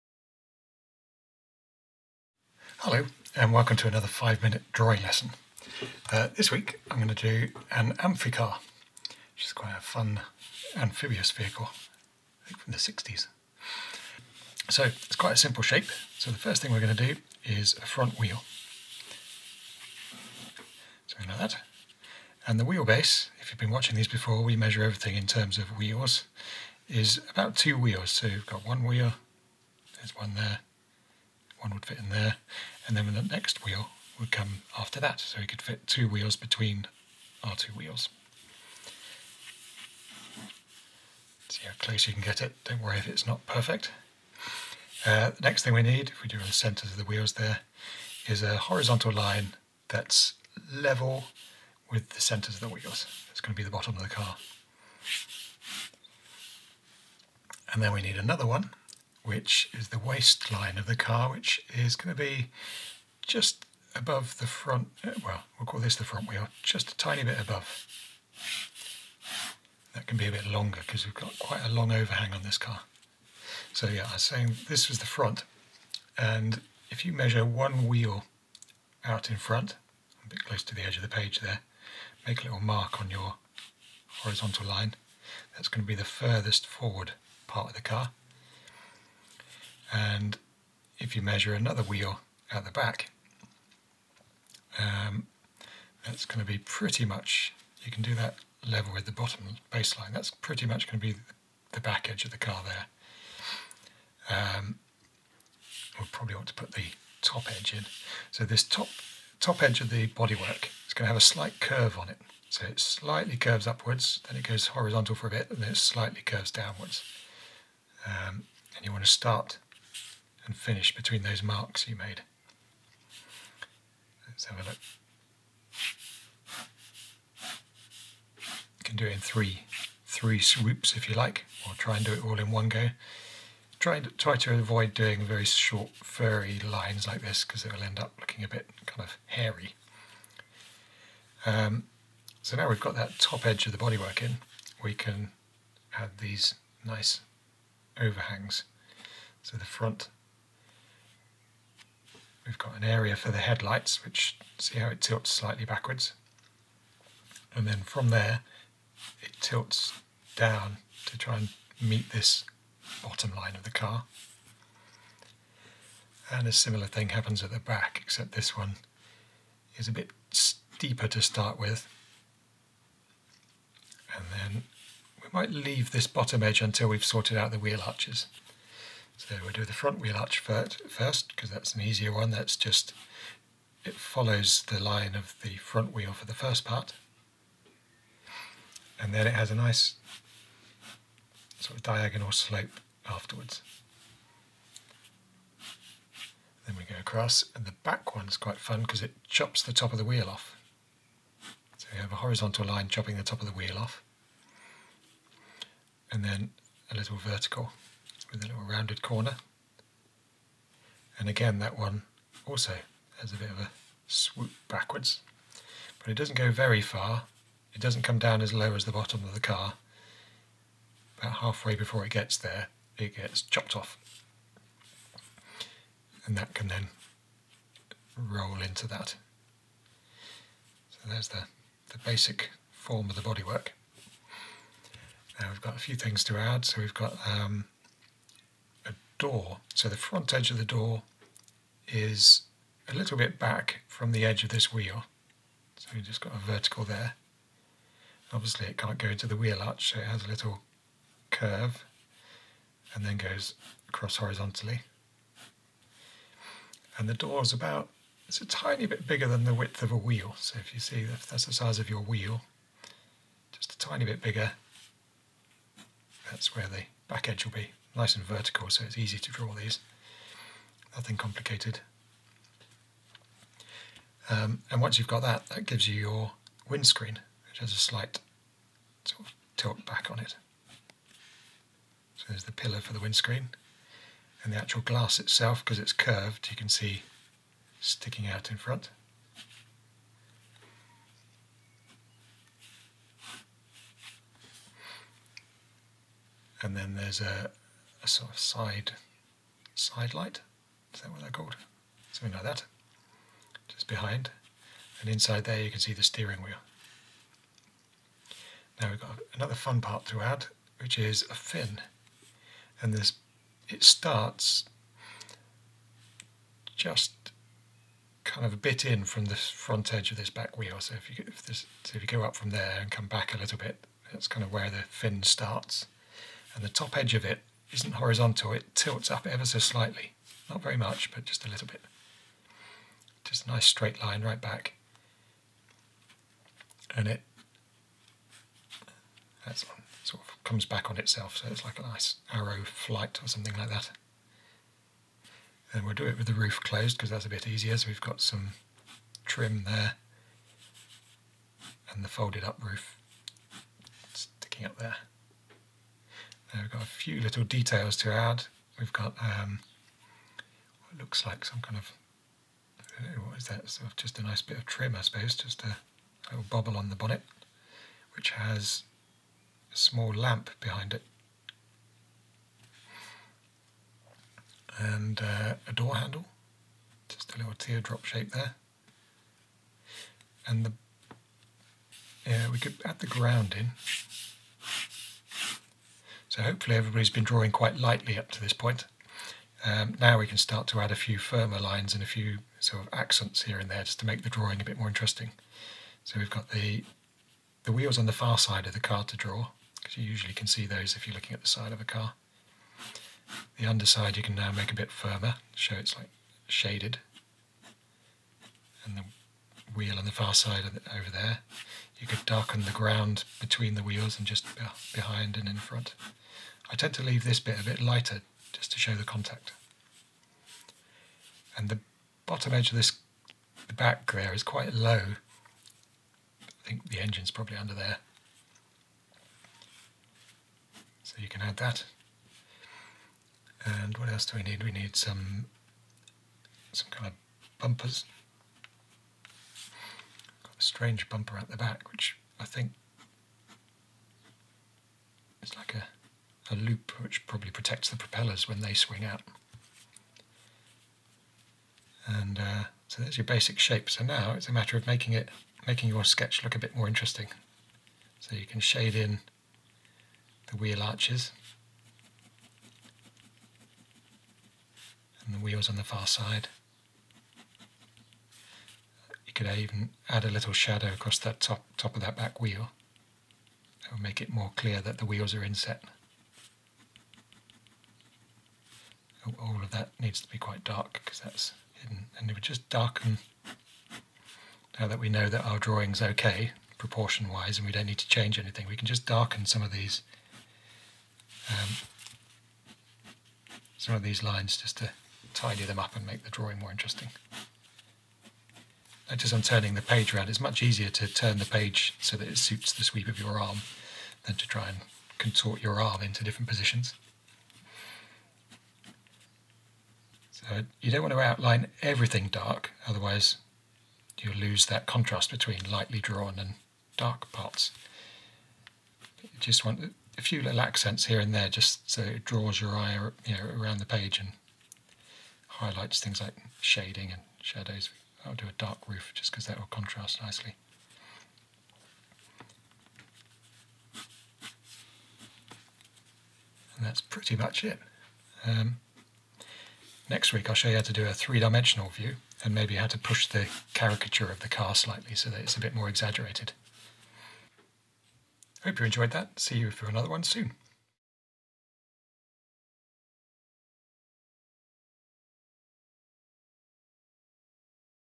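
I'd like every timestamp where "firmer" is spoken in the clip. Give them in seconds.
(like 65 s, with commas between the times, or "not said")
391 s, 404 s.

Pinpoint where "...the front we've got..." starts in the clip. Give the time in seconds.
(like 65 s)
149 s.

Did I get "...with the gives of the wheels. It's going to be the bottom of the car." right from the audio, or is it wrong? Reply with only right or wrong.
wrong.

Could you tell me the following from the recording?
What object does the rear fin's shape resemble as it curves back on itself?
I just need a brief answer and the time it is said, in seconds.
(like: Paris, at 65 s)
arrow flight, at 342 s.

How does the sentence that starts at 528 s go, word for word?
I'll do a dark roof just because that will contrast nicely.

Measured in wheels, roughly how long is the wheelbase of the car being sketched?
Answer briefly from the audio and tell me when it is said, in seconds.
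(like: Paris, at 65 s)
2 wheels, at 27 s.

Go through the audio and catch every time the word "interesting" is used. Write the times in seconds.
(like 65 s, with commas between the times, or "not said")
394 s, 456 s, 496 s.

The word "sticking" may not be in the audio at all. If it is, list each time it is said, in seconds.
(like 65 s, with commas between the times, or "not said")
287 s, 354 s.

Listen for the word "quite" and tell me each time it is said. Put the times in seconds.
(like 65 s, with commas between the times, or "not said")
9 s, 15 s, 71 s, 198 s, 387 s, 424 s, 480 s.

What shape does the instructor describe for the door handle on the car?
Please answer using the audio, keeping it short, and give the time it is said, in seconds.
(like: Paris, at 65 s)
teardrop, at 377 s.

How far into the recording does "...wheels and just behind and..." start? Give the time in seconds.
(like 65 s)
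413 s.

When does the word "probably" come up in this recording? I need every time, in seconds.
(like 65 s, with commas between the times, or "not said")
106 s, 427 s, 447 s.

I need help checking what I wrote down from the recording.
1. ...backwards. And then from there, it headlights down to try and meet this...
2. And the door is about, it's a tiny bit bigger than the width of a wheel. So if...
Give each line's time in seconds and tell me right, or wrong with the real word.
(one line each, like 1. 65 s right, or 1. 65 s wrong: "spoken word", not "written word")
1. 155 s wrong: "tilts", not "headlights"
2. 256 s right.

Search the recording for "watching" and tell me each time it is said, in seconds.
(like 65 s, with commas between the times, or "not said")
23 s.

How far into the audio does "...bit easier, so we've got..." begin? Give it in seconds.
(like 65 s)
347 s.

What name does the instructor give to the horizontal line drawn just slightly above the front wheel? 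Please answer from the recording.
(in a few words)
waistline.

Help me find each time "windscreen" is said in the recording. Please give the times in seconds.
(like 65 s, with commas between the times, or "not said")
276 s, 282 s.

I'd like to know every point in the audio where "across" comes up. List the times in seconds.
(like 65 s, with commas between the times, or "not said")
196 s, 253 s, 470 s.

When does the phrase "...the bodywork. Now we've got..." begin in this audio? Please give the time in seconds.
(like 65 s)
233 s.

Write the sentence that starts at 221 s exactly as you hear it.
About halfway before it gets there, it gets chopped off.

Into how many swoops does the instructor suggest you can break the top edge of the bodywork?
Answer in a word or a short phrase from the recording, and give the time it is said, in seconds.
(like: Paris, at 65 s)
3, at 130 s.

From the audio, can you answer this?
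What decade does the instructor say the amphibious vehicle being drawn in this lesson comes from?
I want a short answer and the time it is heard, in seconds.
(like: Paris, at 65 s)
the 60s, at 12 s.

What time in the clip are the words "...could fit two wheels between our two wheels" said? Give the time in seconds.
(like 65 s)
35 s.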